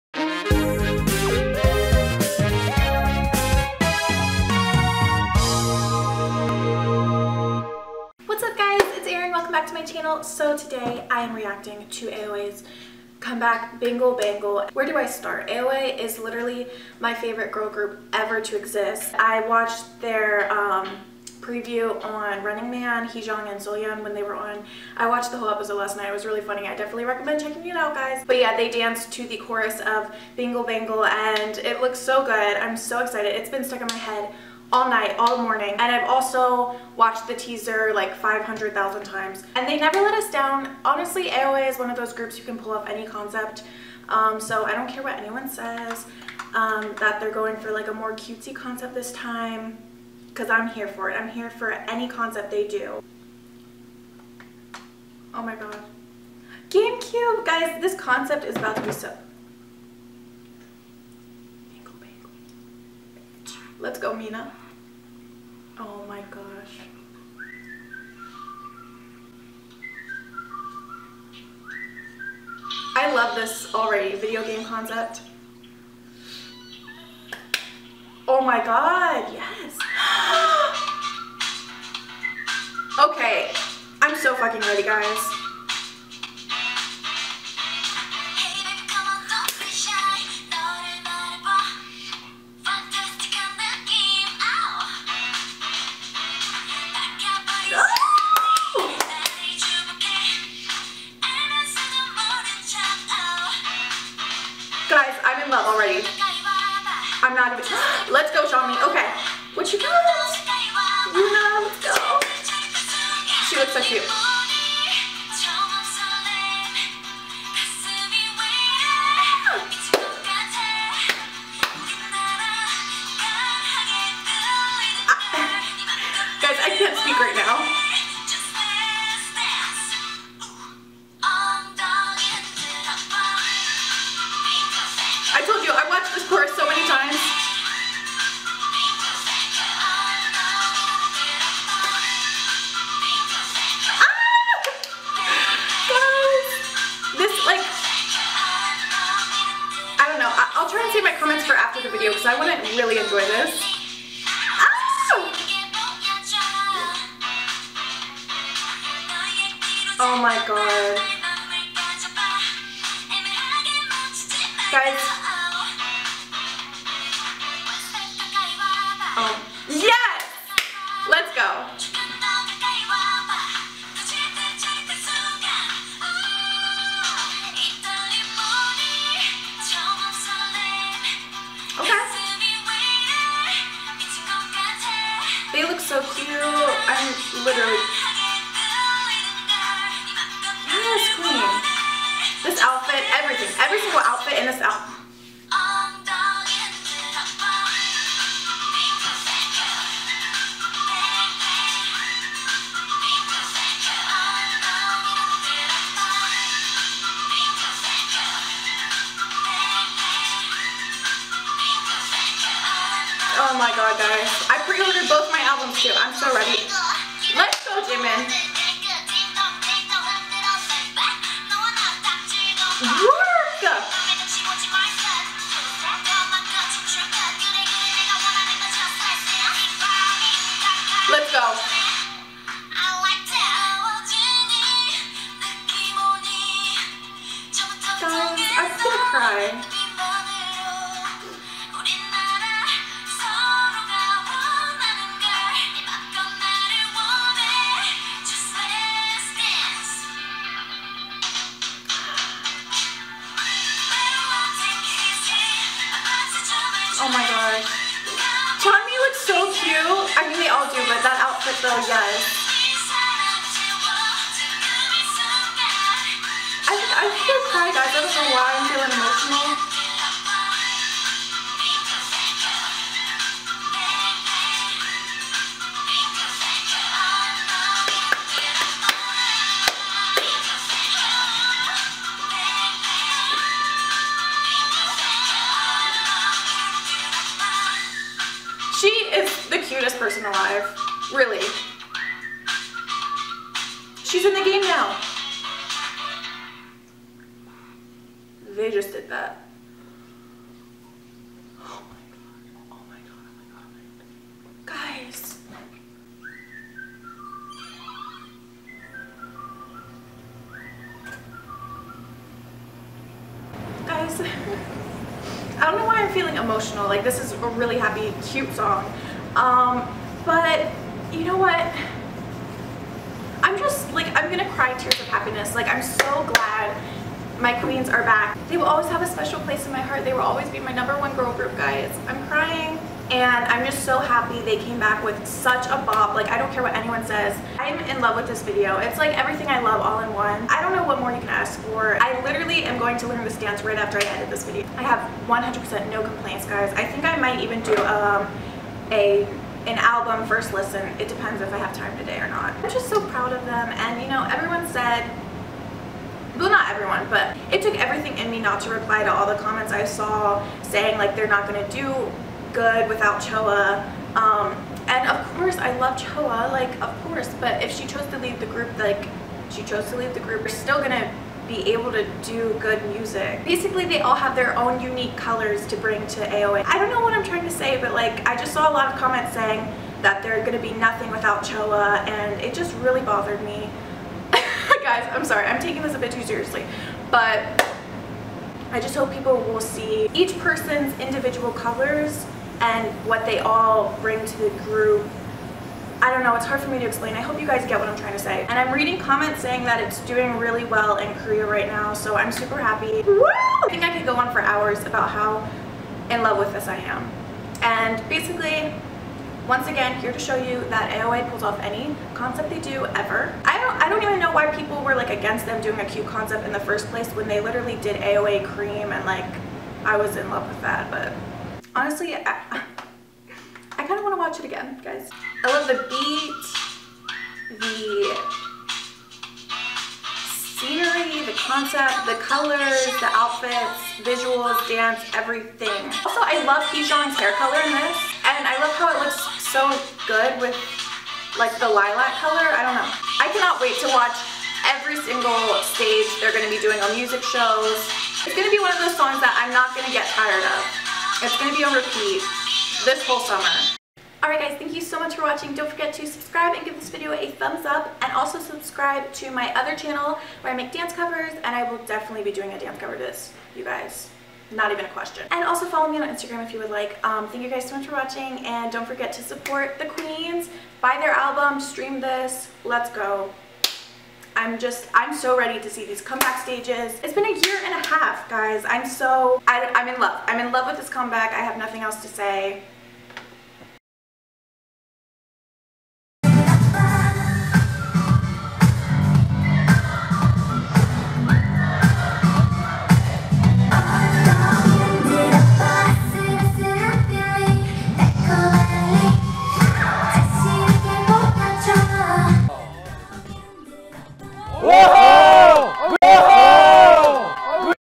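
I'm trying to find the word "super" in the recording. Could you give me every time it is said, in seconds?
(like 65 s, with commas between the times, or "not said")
402 s.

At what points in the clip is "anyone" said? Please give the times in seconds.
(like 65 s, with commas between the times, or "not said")
45 s, 336 s.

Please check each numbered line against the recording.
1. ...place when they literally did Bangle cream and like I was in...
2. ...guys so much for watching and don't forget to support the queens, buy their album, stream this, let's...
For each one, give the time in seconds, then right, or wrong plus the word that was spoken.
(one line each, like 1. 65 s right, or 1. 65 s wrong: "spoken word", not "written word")
1. 416 s wrong: "AOA", not "Bangle"
2. 467 s right.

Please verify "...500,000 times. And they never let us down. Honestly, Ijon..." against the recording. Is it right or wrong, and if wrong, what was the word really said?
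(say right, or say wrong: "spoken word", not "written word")
wrong: "AOA", not "Ijon".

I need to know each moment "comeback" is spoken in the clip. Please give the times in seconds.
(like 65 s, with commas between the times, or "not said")
13 s, 475 s, 480 s.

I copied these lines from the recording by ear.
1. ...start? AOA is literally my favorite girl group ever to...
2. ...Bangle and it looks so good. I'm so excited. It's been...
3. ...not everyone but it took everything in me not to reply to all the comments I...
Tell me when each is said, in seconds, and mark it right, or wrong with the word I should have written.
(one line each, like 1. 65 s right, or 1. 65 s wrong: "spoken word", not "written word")
1. 15 s right
2. 30 s right
3. 356 s right.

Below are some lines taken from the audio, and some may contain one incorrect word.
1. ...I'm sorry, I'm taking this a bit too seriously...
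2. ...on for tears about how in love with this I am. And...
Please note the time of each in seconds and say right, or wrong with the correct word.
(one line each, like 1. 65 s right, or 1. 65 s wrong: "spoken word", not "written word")
1. 385 s right
2. 404 s wrong: "hours", not "tears".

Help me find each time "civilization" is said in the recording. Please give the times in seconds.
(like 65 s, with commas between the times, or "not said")
not said.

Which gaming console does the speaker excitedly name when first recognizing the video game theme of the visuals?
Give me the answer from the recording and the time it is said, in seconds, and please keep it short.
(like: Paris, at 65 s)
GameCube, at 56 s.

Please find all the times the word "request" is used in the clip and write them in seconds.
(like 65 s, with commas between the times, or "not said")
not said.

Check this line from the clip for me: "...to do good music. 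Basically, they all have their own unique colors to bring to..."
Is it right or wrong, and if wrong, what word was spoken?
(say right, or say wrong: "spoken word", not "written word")
right.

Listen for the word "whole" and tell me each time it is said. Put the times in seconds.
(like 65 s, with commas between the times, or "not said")
25 s, 453 s.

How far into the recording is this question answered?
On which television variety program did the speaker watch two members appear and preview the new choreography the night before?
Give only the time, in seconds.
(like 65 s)
22 s.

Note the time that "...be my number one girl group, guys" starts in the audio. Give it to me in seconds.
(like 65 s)
330 s.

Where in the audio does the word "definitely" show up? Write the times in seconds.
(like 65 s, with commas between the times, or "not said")
26 s, 461 s.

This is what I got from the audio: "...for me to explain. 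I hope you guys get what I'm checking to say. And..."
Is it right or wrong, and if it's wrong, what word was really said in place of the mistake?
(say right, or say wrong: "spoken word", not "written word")
wrong: "trying", not "checking".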